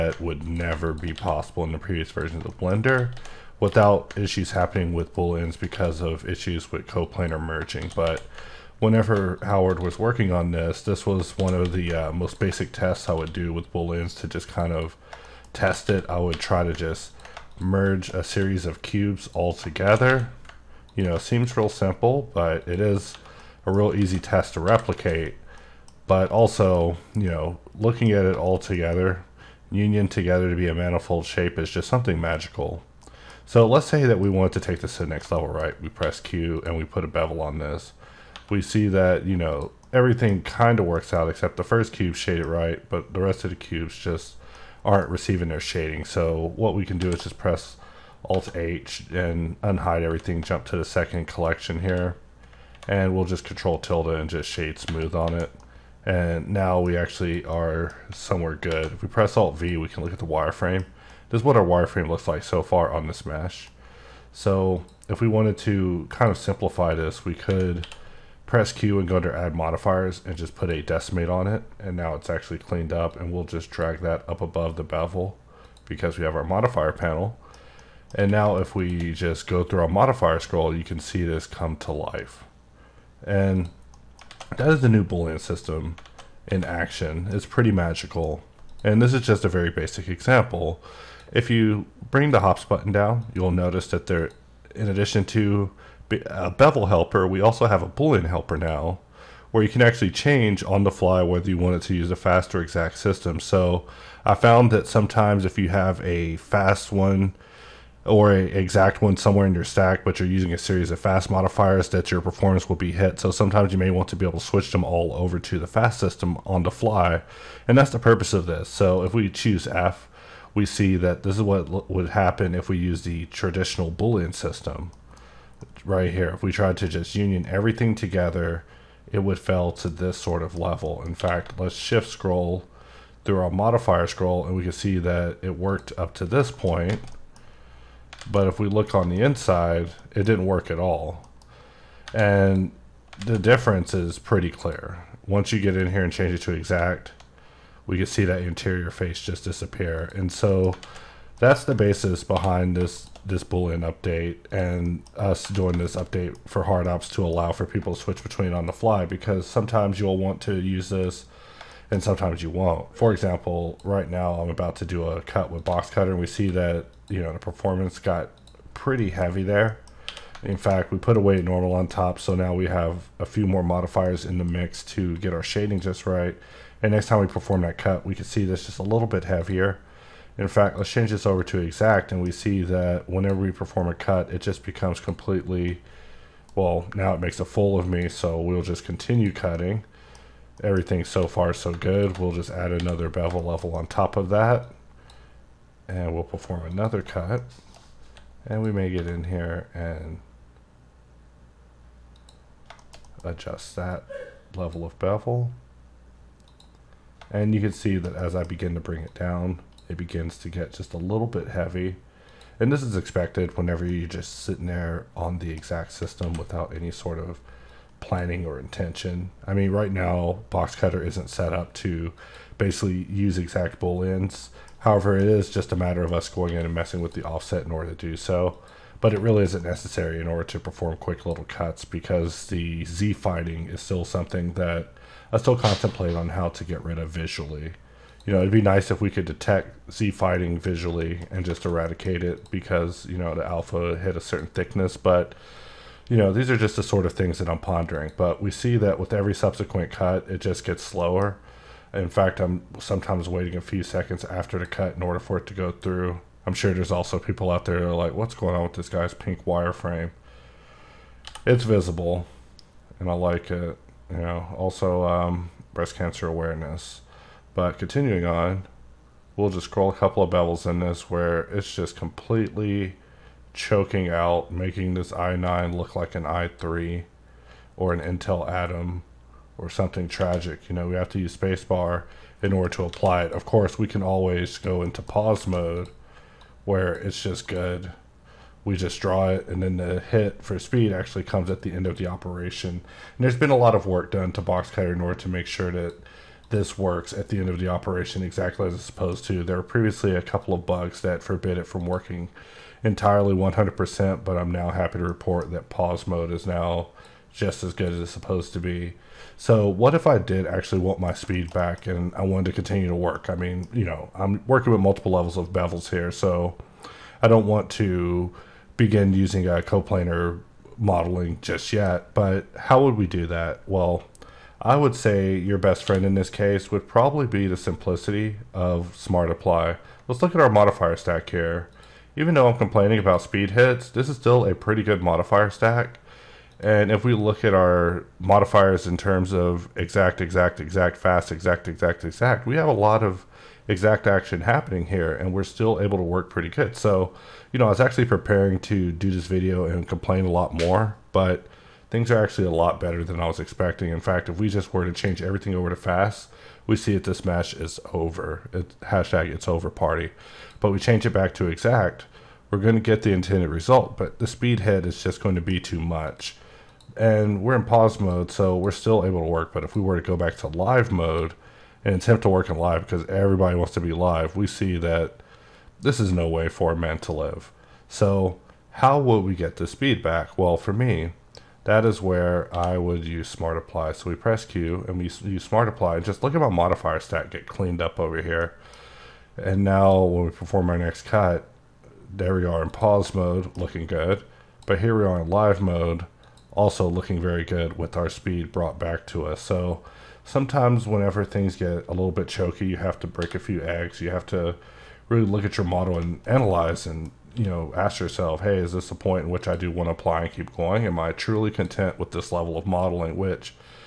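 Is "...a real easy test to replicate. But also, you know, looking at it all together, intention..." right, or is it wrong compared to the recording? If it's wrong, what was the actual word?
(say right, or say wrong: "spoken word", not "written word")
wrong: "union", not "intention".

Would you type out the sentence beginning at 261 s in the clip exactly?
It's visible, and I like it you know, also um, breast cancer awareness.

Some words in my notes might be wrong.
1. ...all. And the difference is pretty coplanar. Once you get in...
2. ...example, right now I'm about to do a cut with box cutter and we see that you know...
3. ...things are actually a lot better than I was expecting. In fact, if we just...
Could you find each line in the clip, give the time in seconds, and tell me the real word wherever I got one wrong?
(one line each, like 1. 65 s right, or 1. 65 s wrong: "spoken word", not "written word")
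1. 140 s wrong: "clear", not "coplanar"
2. 163 s right
3. 351 s right.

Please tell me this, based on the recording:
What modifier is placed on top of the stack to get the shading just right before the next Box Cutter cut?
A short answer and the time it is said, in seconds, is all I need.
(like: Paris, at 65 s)
Weight normal, at 171 s.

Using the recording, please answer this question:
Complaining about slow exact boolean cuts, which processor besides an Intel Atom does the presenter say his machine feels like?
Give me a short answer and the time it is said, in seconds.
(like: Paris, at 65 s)
i3, at 276 s.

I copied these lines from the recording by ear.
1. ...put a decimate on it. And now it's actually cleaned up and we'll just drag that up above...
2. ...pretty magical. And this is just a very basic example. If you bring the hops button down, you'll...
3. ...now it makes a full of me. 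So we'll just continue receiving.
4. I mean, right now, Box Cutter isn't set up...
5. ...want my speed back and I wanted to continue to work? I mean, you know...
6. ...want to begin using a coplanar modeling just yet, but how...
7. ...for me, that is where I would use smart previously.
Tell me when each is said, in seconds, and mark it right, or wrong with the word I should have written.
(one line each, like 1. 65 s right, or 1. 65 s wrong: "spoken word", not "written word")
1. 70 s right
2. 87 s right
3. 186 s wrong: "cutting", not "receiving"
4. 219 s right
5. 310 s right
6. 317 s right
7. 380 s wrong: "apply", not "previously".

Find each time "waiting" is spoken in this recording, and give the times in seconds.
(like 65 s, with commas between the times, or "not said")
253 s.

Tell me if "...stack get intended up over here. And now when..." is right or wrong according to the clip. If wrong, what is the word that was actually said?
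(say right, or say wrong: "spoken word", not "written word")
wrong: "cleaned", not "intended".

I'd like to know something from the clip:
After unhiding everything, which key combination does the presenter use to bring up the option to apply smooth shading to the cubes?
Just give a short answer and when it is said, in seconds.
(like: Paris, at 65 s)
Control tilde, at 53 s.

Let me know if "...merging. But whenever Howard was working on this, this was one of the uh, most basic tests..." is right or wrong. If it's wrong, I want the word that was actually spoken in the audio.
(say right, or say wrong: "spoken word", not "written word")
right.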